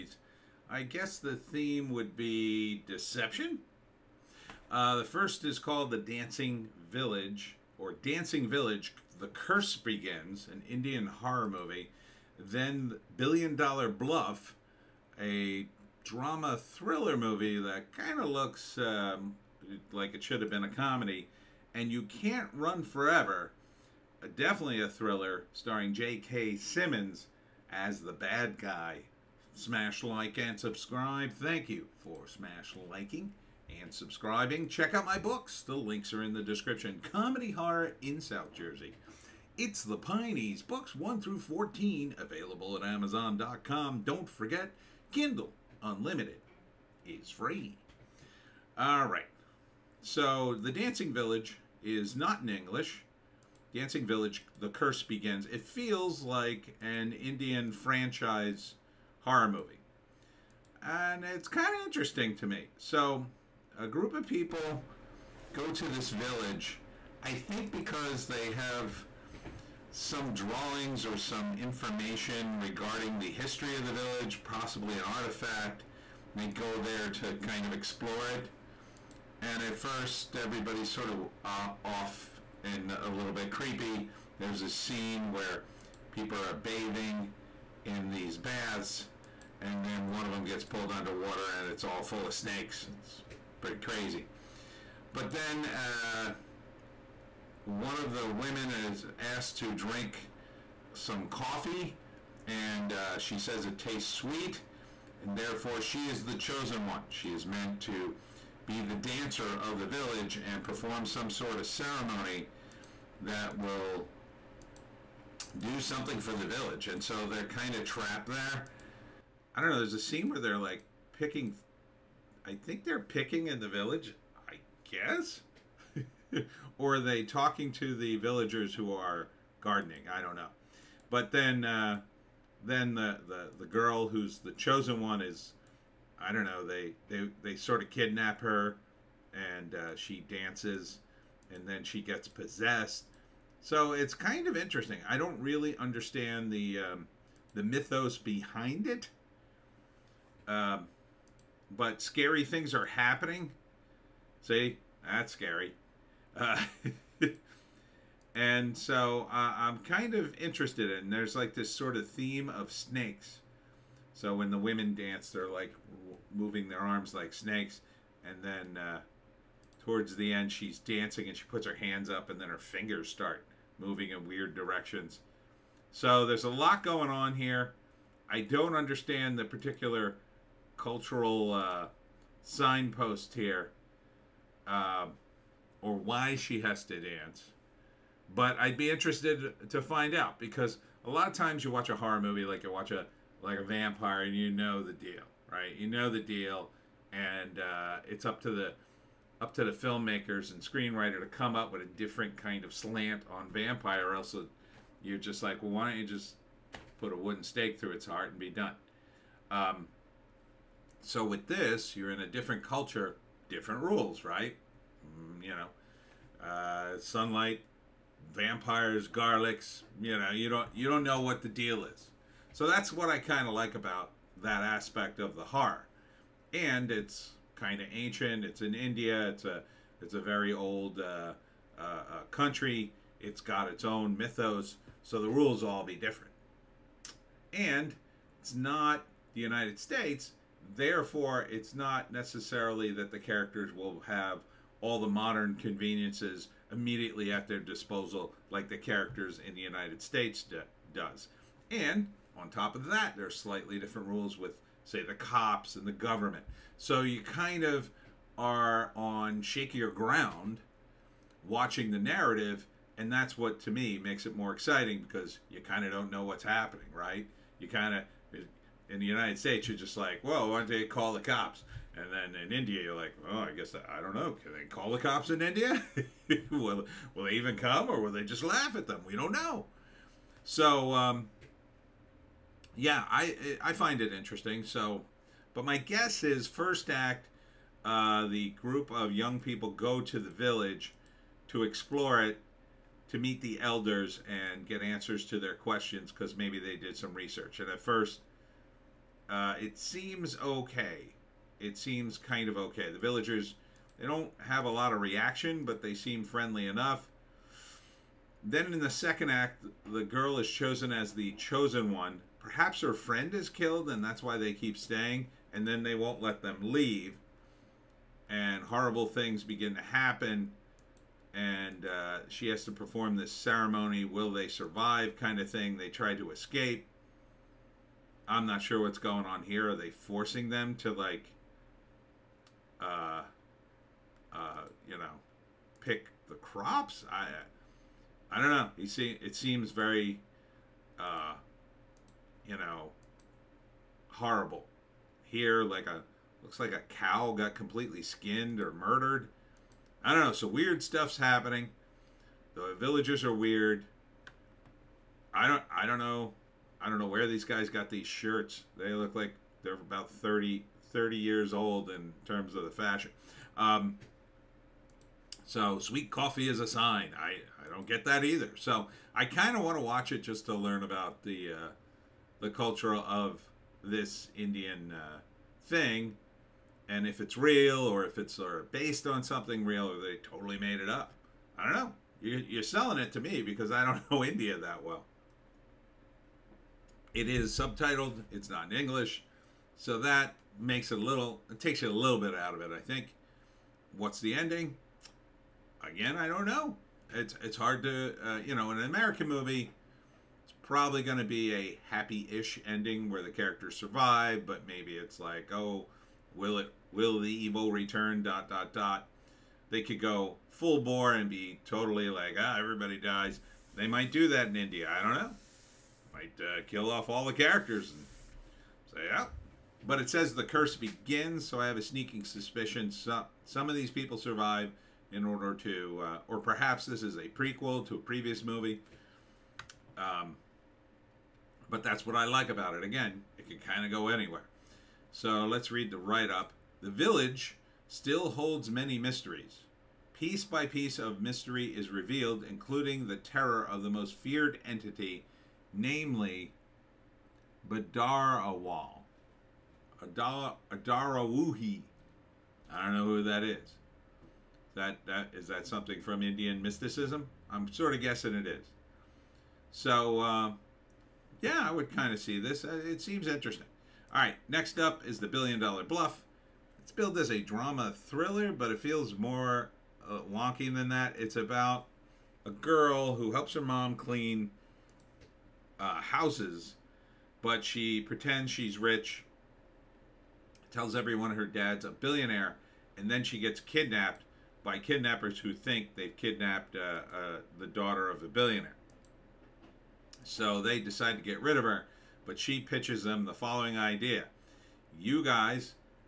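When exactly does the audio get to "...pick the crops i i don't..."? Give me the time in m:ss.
5:35.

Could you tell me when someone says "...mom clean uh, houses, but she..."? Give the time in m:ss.
7:53.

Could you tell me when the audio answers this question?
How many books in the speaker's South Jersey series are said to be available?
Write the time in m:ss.
0:40.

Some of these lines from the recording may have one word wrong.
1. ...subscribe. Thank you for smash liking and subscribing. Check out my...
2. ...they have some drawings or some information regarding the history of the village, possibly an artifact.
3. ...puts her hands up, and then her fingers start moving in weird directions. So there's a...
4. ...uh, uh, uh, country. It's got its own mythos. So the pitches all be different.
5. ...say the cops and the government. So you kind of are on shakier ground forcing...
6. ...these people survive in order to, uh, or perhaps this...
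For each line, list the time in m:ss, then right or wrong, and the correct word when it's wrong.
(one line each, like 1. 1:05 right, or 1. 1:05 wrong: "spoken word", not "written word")
1. 0:30 right
2. 1:08 right
3. 2:51 right
4. 3:51 wrong: "rules", not "pitches"
5. 4:14 wrong: "watching", not "forcing"
6. 7:03 right.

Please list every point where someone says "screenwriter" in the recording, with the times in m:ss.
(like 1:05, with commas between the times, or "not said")
3:20.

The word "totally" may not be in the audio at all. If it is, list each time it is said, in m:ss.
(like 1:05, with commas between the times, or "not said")
6:20, 6:51.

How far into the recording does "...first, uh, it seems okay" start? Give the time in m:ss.
4:57.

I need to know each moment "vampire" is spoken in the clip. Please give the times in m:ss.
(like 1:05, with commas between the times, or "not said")
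3:13, 3:23, 3:38.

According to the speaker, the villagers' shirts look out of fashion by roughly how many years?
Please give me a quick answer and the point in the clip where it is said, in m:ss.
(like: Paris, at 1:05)
30, at 6:00.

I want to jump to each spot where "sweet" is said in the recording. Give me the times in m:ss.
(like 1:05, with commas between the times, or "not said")
1:44, 6:05.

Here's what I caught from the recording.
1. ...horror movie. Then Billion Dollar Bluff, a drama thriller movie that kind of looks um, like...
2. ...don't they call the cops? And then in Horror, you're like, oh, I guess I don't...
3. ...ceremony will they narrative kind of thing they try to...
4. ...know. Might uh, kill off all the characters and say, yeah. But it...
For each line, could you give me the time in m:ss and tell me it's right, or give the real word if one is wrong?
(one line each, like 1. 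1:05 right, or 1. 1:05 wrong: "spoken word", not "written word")
1. 0:11 right
2. 4:30 wrong: "India", not "Horror"
3. 5:23 wrong: "survive", not "narrative"
4. 6:55 right.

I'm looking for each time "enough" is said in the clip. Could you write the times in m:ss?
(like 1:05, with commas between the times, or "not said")
5:06.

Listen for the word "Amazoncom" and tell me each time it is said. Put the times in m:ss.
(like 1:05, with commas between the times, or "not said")
0:42.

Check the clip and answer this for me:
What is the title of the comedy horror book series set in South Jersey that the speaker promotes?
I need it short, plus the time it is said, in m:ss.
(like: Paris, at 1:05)
The Pineys, at 0:39.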